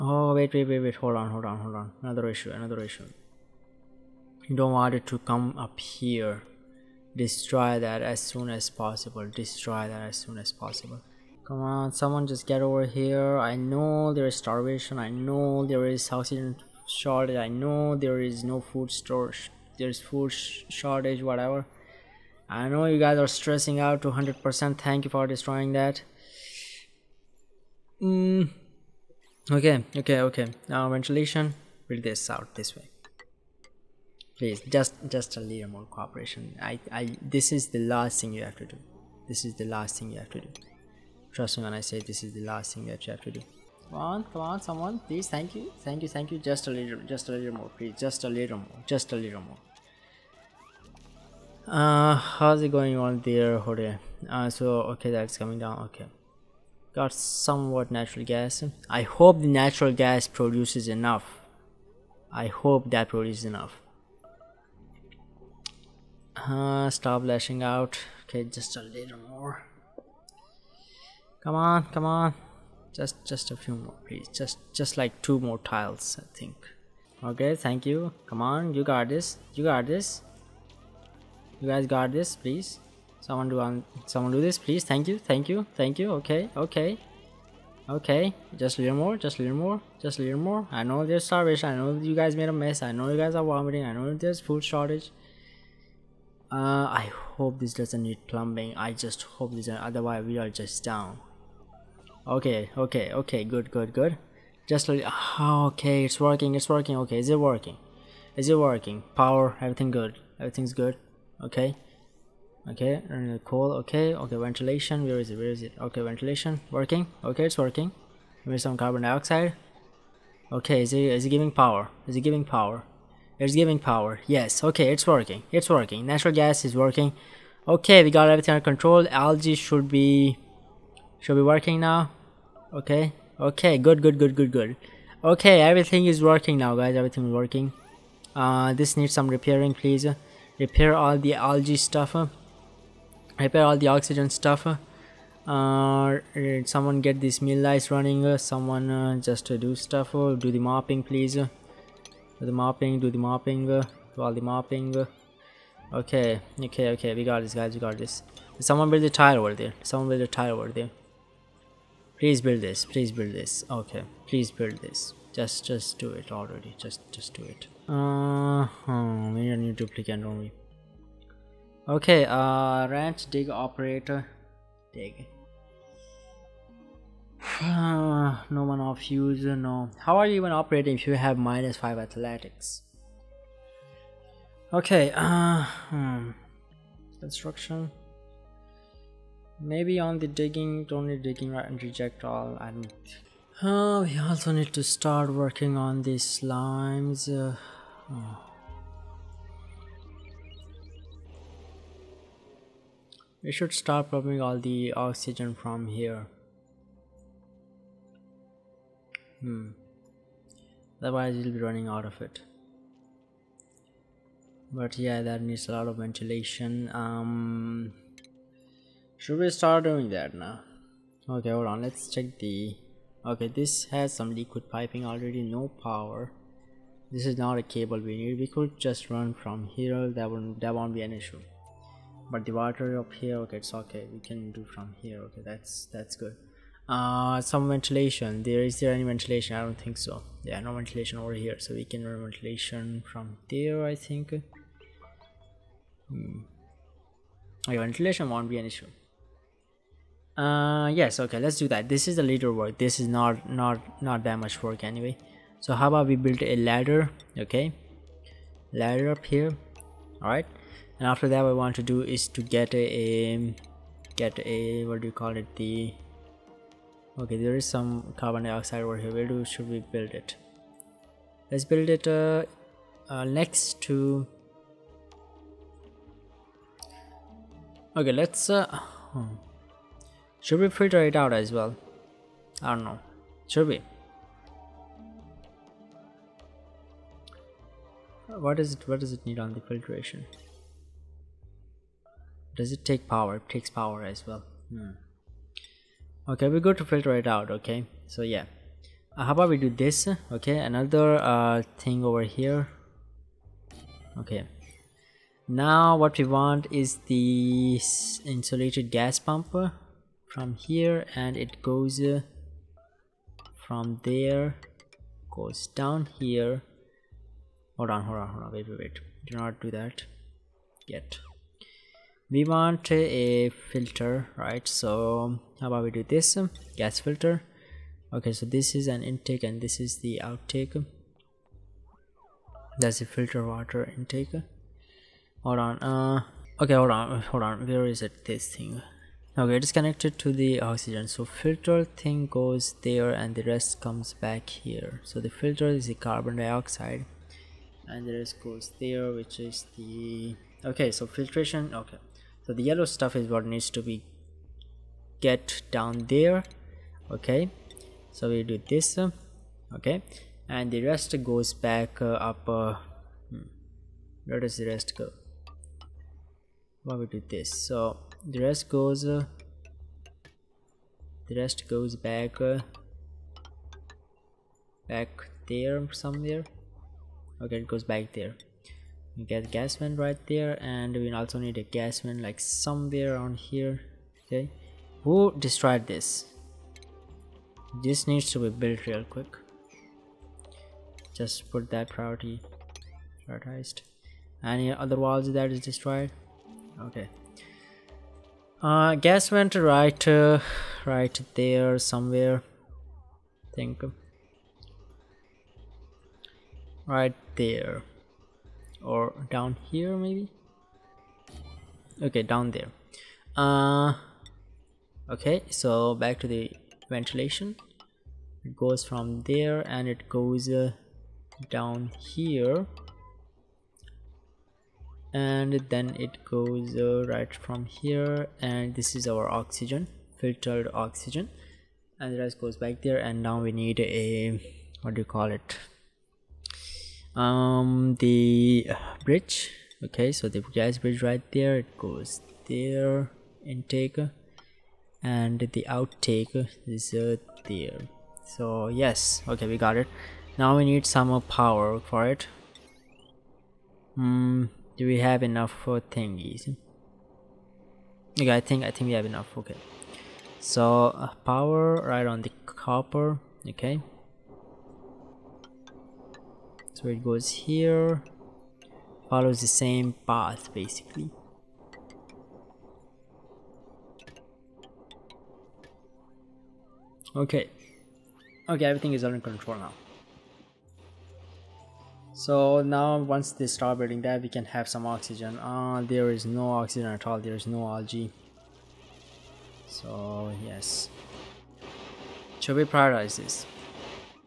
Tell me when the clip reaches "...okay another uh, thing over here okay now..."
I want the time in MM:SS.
05:00.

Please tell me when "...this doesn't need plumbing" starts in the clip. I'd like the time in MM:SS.
01:37.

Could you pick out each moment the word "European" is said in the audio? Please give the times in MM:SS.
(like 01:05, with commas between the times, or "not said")
not said.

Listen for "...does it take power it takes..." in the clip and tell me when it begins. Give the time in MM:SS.
04:52.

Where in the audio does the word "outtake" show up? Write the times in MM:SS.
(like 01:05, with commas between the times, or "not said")
05:30, 07:25.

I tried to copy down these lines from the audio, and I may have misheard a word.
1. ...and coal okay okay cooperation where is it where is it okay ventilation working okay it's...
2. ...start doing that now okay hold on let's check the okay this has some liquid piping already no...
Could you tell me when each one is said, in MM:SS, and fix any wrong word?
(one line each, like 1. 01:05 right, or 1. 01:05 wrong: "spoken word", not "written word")
1. 01:53 wrong: "ventilation", not "cooperation"
2. 03:39 right.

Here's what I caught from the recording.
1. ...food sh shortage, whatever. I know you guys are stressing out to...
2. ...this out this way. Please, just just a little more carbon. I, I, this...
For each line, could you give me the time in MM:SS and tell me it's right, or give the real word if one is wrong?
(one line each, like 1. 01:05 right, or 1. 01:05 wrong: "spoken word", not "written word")
1. 00:19 right
2. 00:32 wrong: "cooperation", not "carbon".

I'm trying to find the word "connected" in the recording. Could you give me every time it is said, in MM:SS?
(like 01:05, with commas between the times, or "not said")
05:39.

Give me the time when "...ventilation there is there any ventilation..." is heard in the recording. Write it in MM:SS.
03:57.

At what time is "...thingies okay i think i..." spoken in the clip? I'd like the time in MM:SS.
07:35.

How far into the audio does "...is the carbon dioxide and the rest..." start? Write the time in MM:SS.
05:45.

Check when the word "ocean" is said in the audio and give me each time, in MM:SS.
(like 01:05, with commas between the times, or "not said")
not said.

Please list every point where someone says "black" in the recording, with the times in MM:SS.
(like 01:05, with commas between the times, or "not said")
not said.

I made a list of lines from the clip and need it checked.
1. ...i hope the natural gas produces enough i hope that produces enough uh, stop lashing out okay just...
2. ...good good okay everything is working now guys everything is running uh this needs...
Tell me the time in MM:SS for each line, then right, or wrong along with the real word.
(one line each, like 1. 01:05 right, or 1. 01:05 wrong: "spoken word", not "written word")
1. 00:58 right
2. 02:14 wrong: "working", not "running".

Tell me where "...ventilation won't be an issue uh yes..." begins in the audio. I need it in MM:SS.
04:07.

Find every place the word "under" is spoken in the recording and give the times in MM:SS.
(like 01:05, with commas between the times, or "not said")
02:08, 07:59.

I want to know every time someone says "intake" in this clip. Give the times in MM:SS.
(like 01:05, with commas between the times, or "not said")
05:29, 05:33, 07:23.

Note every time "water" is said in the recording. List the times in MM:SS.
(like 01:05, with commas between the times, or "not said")
03:52, 05:33.